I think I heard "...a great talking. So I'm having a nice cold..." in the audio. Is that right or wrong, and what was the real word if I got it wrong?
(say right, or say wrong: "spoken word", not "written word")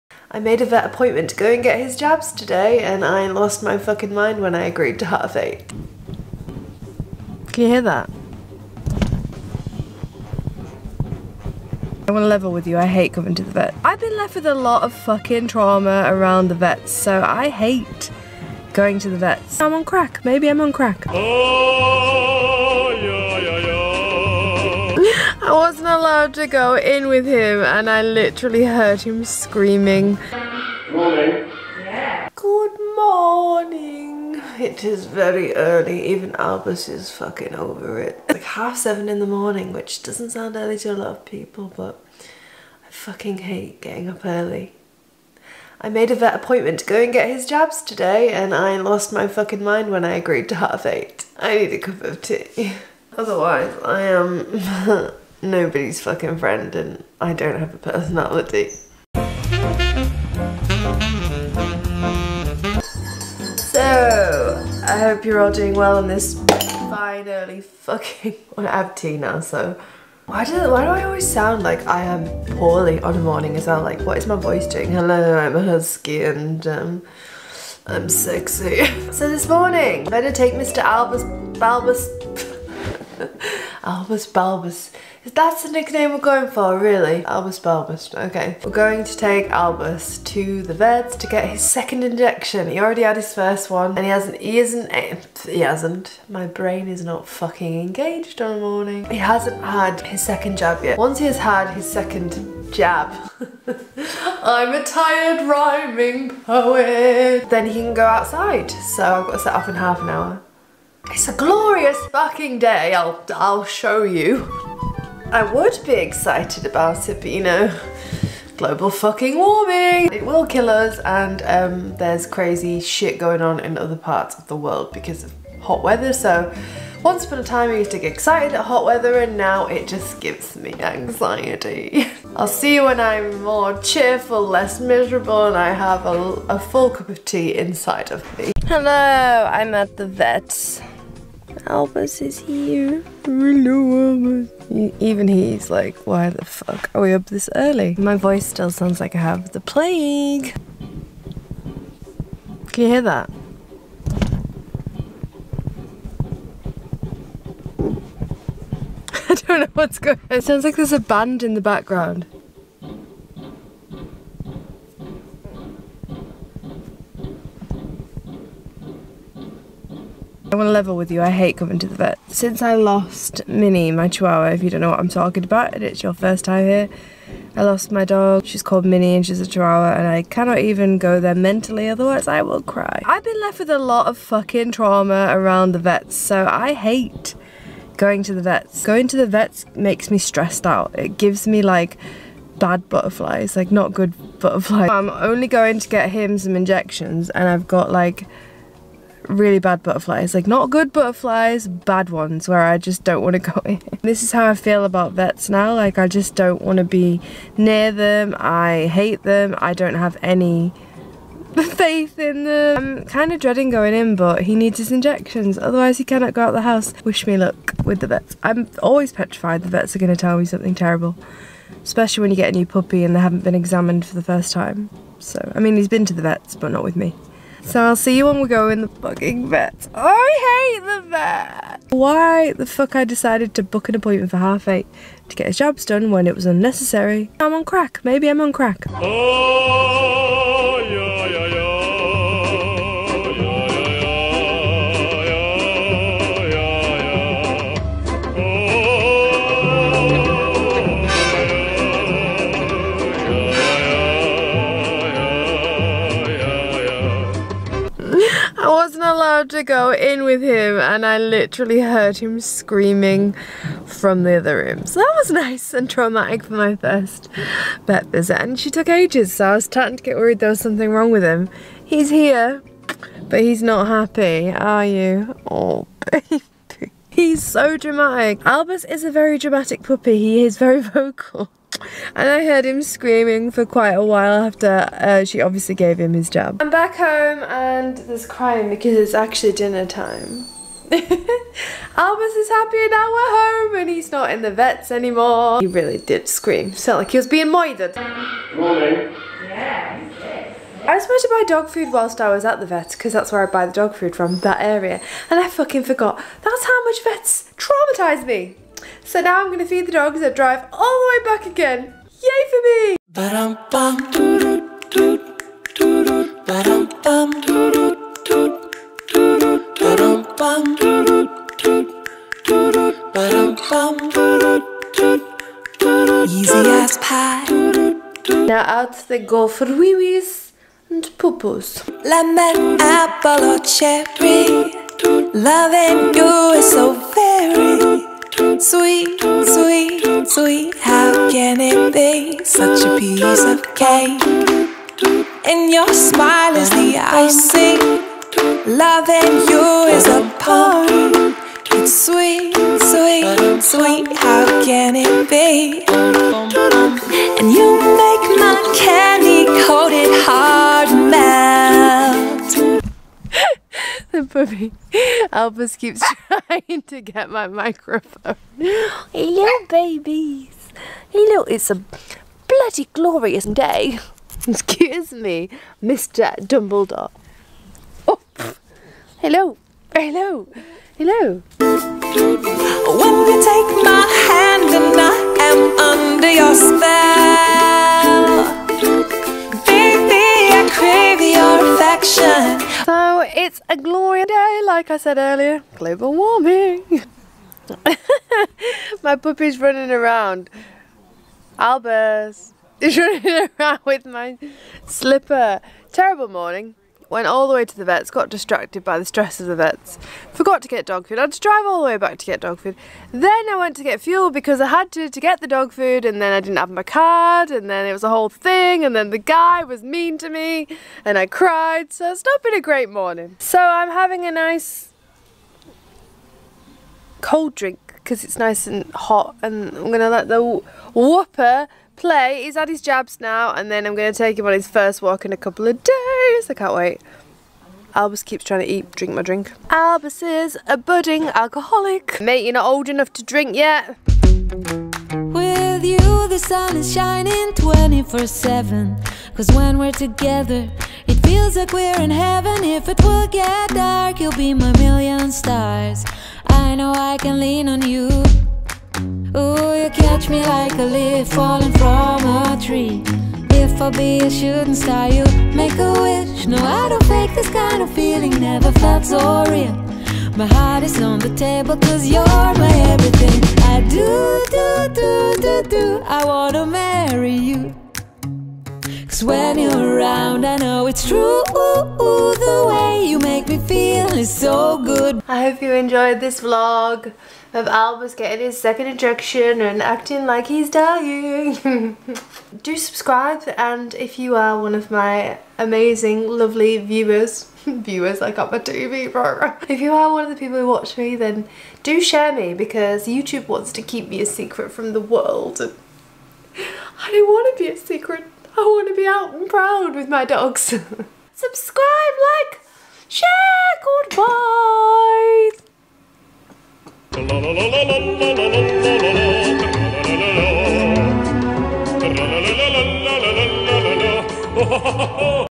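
wrong: "morning", not "talking".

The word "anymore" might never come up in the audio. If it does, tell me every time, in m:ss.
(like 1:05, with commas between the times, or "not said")
4:54.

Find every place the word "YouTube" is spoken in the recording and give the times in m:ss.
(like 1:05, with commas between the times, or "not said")
8:23.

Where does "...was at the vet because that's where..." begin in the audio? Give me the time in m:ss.
5:02.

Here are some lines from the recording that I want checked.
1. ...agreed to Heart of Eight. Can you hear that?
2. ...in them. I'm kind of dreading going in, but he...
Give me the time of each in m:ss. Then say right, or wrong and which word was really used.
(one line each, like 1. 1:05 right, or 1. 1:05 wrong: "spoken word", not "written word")
1. 0:04 right
2. 3:32 right.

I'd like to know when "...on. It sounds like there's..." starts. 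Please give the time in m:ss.
2:40.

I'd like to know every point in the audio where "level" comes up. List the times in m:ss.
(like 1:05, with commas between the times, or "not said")
0:12, 2:50.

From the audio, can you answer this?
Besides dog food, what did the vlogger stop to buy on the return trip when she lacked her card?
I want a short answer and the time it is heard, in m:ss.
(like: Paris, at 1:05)
Fuel, at 6:53.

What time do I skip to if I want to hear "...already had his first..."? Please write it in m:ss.
1:32.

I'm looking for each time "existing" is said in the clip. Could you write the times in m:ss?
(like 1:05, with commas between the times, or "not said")
not said.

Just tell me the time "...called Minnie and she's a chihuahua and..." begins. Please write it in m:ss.
2:58.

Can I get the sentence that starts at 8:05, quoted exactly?
I hope you enjoyed this vlog of Albus getting his second injection and acting like he's dying.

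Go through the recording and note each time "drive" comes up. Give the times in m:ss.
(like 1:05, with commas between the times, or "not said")
5:10, 6:51.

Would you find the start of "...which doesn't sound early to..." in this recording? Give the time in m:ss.
0:39.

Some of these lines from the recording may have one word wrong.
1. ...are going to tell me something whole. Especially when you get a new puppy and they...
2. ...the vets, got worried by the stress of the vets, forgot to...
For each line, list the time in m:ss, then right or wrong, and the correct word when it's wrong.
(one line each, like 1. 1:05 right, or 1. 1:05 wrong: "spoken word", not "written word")
1. 3:39 wrong: "terrible", not "whole"
2. 6:47 wrong: "distracted", not "worried".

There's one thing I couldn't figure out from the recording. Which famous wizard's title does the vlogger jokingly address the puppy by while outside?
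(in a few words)
Mr. Dumbledore.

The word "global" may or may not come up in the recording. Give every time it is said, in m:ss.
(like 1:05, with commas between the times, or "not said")
1:58, 6:35.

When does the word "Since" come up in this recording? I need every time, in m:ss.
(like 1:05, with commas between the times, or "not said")
2:52.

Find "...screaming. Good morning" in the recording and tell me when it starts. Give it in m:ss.
0:29.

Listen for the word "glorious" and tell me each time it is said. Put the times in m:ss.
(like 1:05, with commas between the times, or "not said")
1:51, 6:12, 6:33.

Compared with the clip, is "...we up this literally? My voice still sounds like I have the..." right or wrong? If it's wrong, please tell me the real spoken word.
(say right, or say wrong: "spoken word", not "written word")
wrong: "early", not "literally".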